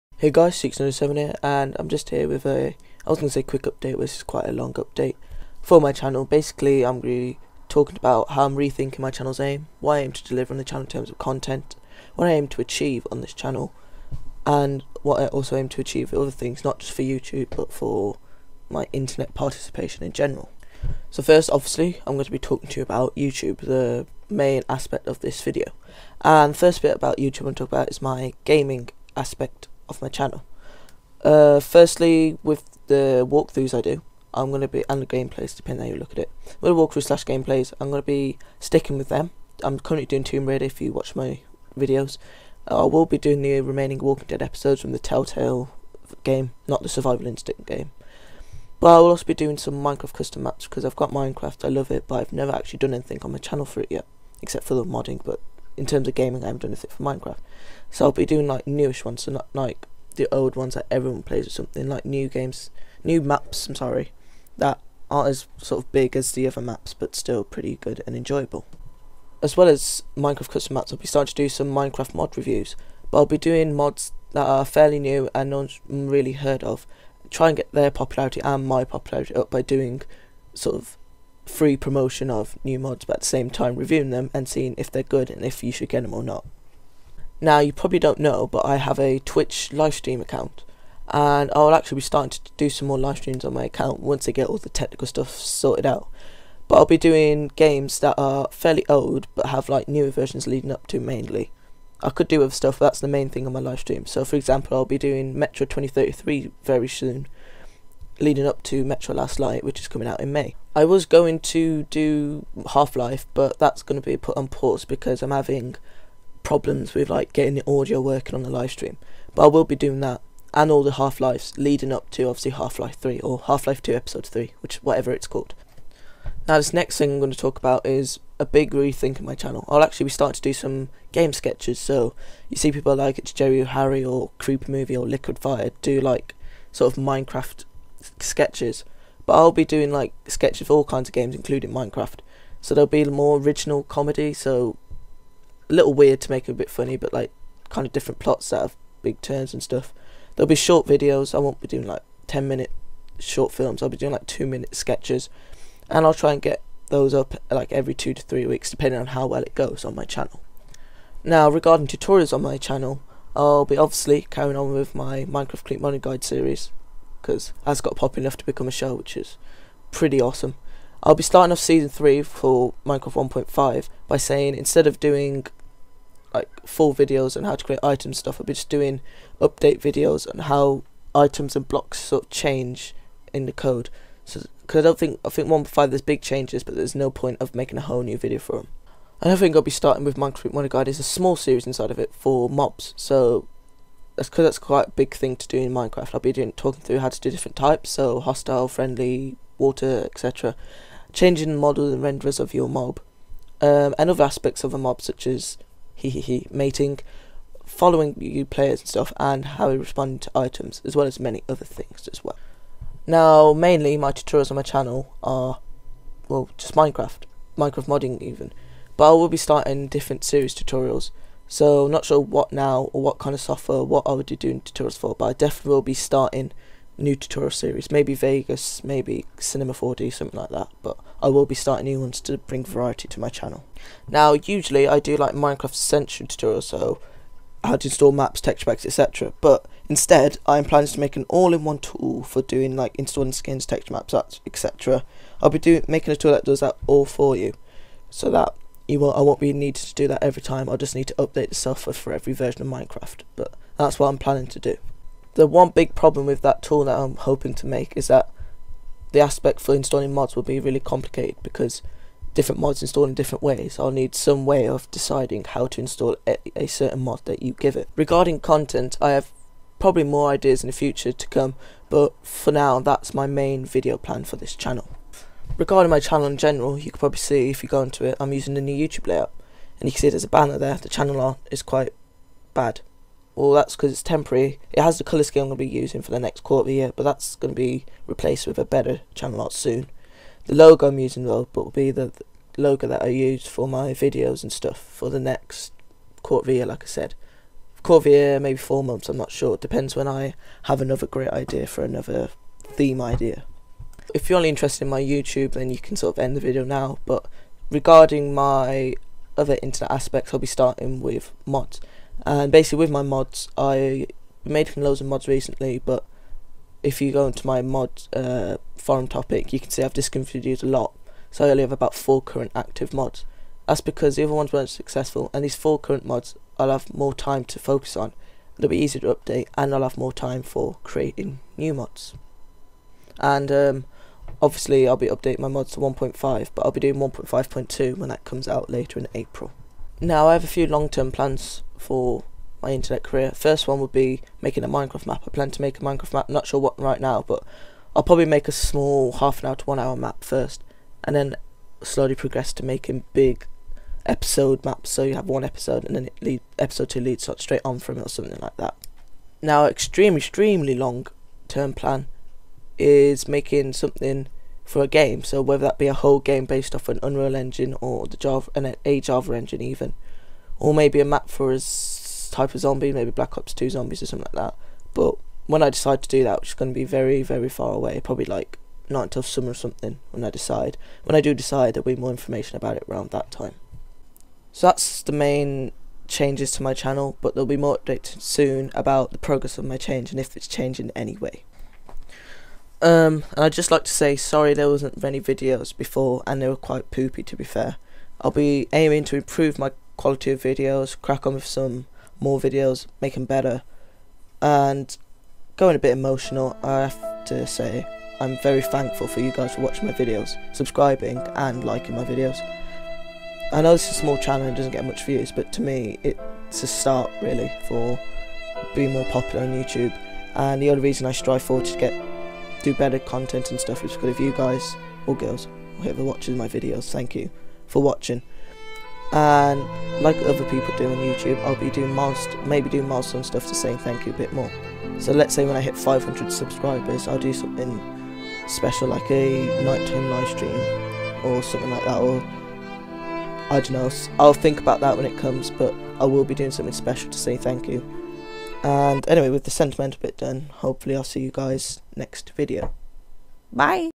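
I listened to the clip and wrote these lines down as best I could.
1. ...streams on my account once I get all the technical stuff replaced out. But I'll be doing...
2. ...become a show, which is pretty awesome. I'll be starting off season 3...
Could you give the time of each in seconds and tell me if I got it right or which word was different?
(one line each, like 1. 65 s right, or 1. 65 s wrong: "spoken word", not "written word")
1. 93 s wrong: "sorted", not "replaced"
2. 168 s right.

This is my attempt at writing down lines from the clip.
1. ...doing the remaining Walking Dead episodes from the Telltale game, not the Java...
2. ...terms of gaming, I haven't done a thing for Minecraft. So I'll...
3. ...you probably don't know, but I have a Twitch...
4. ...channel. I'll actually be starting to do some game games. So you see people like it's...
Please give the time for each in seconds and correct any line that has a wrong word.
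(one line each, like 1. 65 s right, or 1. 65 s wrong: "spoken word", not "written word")
1. 43 s wrong: "Survival", not "Java"
2. 55 s right
3. 87 s right
4. 129 s wrong: "sketches", not "games".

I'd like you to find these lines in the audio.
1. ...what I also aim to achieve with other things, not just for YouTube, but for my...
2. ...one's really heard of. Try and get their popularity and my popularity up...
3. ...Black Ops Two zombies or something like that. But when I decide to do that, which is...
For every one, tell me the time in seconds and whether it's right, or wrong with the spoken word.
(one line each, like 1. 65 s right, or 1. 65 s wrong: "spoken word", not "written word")
1. 15 s right
2. 75 s right
3. 373 s right.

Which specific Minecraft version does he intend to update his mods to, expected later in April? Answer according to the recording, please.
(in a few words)
1.5.2.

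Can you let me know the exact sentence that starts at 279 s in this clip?
And you can see there's a banner there, the channel art is quite bad.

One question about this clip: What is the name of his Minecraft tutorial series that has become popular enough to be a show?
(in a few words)
Minecraft Click Money Guide.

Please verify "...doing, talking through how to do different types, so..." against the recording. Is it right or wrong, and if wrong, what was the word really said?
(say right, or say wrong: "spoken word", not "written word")
right.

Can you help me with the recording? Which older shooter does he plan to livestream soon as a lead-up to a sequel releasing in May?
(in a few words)
Metro 2033.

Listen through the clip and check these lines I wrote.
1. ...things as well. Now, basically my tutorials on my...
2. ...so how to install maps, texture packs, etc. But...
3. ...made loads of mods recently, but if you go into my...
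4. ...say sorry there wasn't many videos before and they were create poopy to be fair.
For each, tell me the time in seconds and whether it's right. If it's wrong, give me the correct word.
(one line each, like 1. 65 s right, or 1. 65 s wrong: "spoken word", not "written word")
1. 211 s wrong: "mainly", not "basically"
2. 236 s right
3. 314 s right
4. 393 s wrong: "quite", not "create".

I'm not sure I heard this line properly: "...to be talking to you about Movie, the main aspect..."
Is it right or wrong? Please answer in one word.
wrong.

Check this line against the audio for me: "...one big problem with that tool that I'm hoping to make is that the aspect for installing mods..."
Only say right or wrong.
right.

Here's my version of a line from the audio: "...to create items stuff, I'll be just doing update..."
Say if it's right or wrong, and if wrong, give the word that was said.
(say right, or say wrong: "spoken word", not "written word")
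right.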